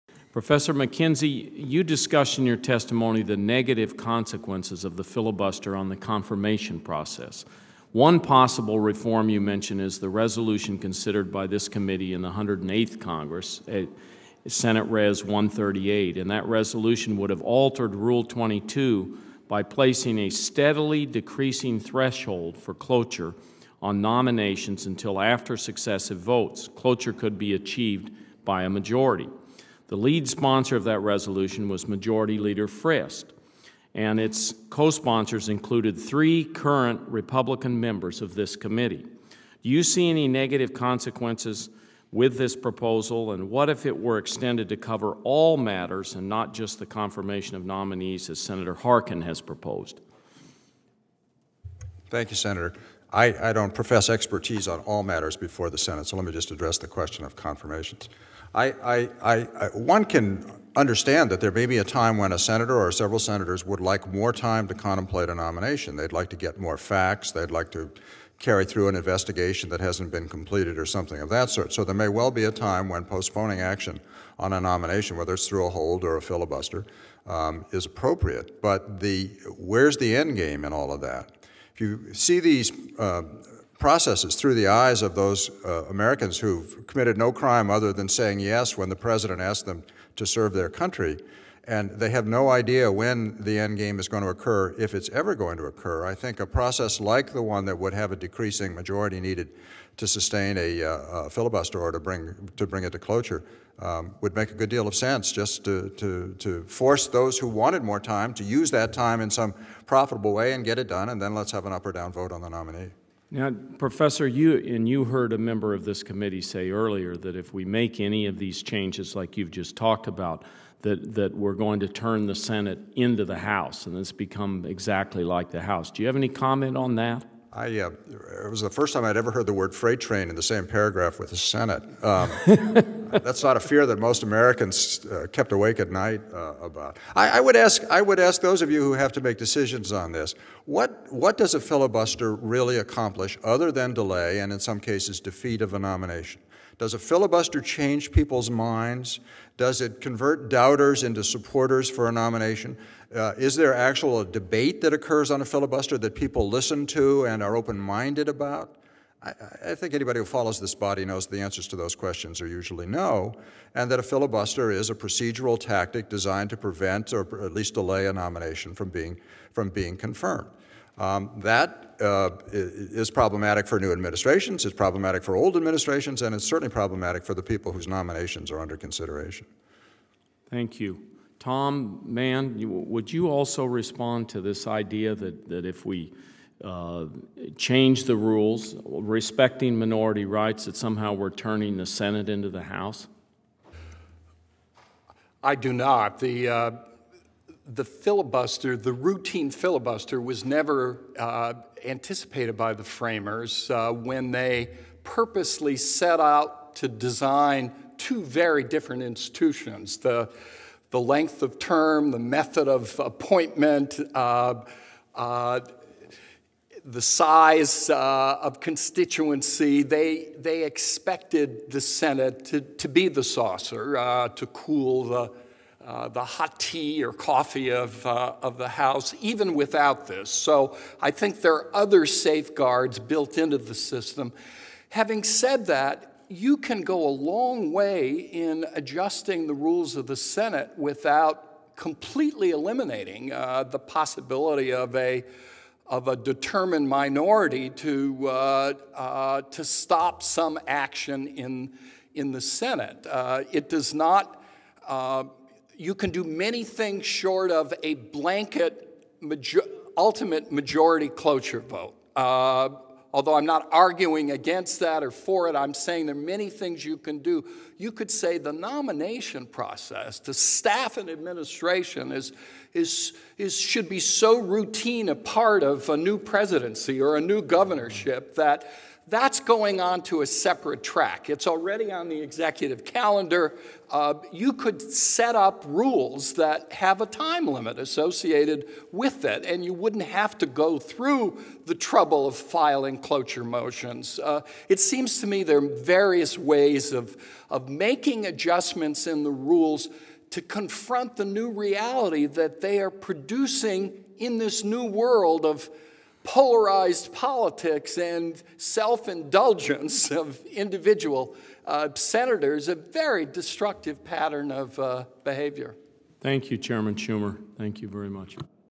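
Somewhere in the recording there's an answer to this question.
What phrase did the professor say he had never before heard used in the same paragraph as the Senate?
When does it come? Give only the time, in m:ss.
2:09.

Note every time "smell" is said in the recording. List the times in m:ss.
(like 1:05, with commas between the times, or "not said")
not said.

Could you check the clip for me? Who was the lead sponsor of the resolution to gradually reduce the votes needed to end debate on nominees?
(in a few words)
Majority Leader Frist.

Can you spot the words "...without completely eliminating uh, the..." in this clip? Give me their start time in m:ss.
4:00.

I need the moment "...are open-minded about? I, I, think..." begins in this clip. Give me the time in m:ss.
2:37.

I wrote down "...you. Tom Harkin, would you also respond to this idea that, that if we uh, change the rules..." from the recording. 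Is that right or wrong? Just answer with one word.
wrong.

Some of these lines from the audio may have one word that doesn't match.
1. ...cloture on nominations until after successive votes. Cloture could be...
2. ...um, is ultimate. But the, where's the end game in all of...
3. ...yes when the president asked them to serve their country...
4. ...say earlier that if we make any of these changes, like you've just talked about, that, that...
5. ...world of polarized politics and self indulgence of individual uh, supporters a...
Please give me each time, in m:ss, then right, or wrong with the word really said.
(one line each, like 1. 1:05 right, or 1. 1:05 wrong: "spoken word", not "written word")
1. 0:22 right
2. 1:17 wrong: "appropriate", not "ultimate"
3. 1:28 right
4. 1:56 right
5. 5:04 wrong: "senators", not "supporters".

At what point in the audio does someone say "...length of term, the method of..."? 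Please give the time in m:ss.
3:31.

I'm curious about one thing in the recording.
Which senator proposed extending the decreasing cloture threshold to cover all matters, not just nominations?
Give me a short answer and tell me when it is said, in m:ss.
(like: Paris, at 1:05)
Senator Harkin, at 0:48.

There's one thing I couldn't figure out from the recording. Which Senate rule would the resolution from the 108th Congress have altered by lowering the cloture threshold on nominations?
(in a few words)
Rule 22.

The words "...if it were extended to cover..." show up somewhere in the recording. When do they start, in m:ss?
0:43.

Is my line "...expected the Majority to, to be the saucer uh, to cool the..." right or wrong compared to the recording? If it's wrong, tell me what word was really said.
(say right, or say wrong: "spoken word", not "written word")
wrong: "Senate", not "Majority".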